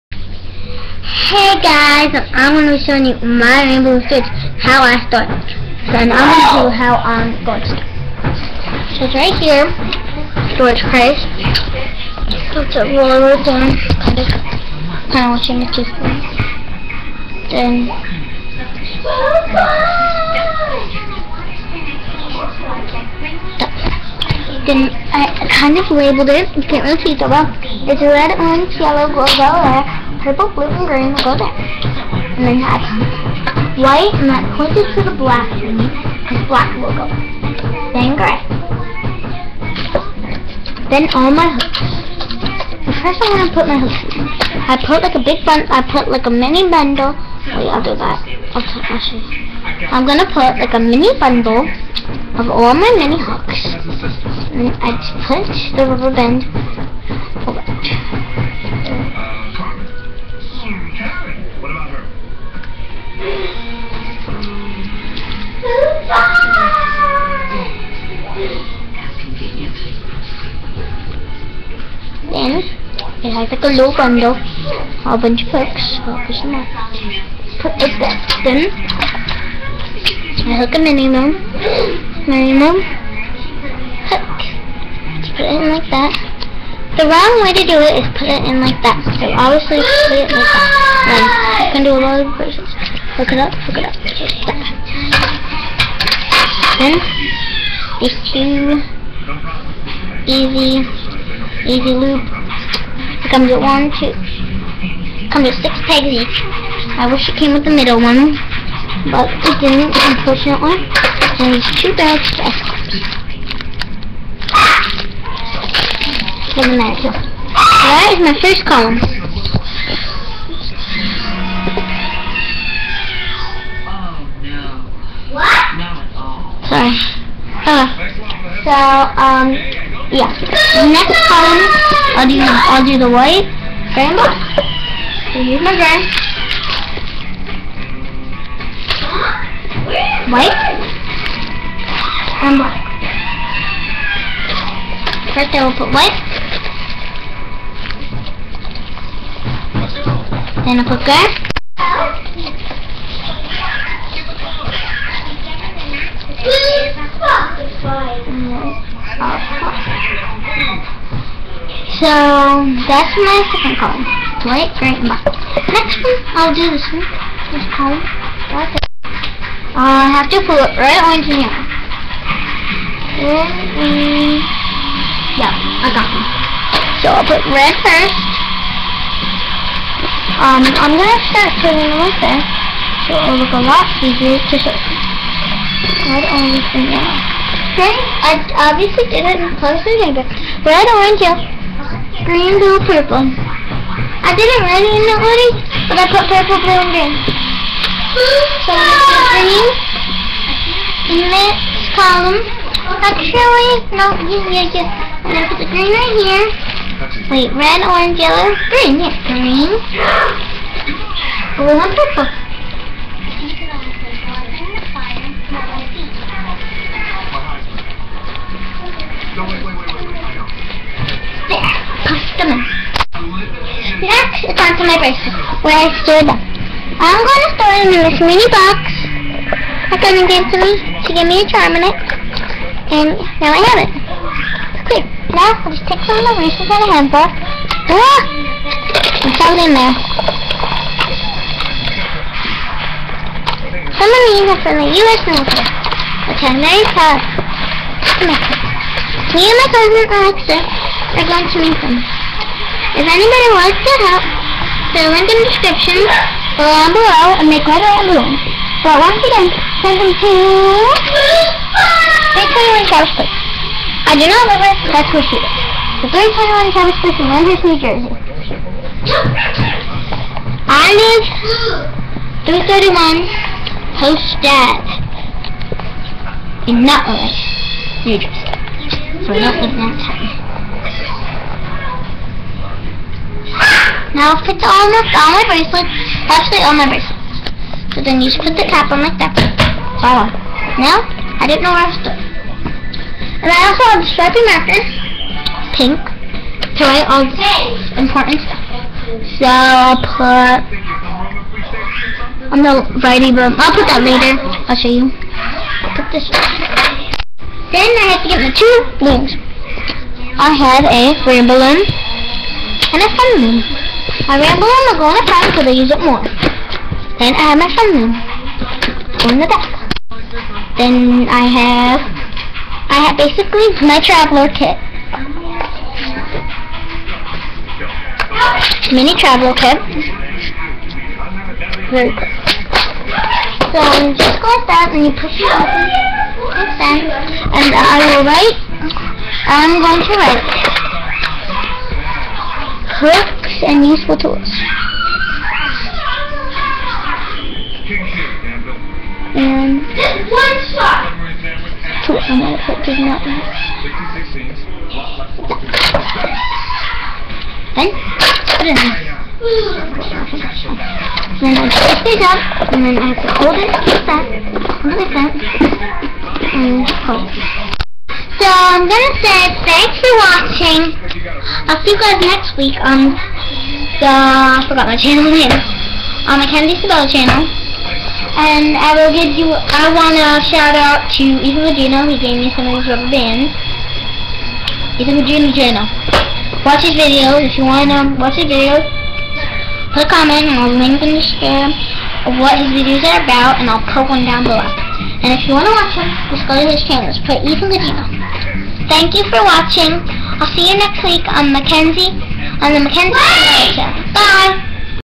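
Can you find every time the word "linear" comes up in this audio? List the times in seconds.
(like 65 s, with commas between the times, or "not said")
not said.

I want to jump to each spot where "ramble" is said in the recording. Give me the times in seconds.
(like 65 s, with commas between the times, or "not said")
314 s.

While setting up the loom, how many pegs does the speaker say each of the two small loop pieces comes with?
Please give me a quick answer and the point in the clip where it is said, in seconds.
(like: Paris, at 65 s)
6, at 105 s.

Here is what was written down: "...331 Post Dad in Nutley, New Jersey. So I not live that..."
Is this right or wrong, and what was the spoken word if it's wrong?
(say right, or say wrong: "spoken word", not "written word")
right.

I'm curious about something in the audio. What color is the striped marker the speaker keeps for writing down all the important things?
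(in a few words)
Pink.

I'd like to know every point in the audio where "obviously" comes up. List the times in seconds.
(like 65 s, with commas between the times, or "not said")
89 s, 188 s.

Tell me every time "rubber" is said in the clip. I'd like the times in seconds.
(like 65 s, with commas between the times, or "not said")
55 s, 382 s.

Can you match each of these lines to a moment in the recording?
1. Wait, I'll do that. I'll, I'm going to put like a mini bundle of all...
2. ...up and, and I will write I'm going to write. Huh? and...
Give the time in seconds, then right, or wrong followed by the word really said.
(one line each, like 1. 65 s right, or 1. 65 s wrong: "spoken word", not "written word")
1. 47 s right
2. 335 s right.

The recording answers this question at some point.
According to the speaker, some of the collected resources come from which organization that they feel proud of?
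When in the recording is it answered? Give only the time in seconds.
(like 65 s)
245 s.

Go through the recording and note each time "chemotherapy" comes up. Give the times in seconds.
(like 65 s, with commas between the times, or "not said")
not said.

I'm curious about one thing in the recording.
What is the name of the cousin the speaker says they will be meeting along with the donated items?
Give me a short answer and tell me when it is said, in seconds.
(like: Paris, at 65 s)
Alexa, at 250 s.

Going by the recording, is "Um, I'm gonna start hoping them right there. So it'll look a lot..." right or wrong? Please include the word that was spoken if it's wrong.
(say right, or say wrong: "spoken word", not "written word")
wrong: "putting", not "hoping".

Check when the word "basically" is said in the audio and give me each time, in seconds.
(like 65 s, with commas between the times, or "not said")
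323 s.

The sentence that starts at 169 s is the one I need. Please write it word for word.
Uh, I have to pull it right on yellow.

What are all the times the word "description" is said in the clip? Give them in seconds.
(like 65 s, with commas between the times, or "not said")
255 s, 391 s.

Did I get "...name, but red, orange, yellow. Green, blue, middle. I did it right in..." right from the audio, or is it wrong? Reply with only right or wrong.
wrong.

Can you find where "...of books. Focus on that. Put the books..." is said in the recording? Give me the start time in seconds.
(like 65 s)
75 s.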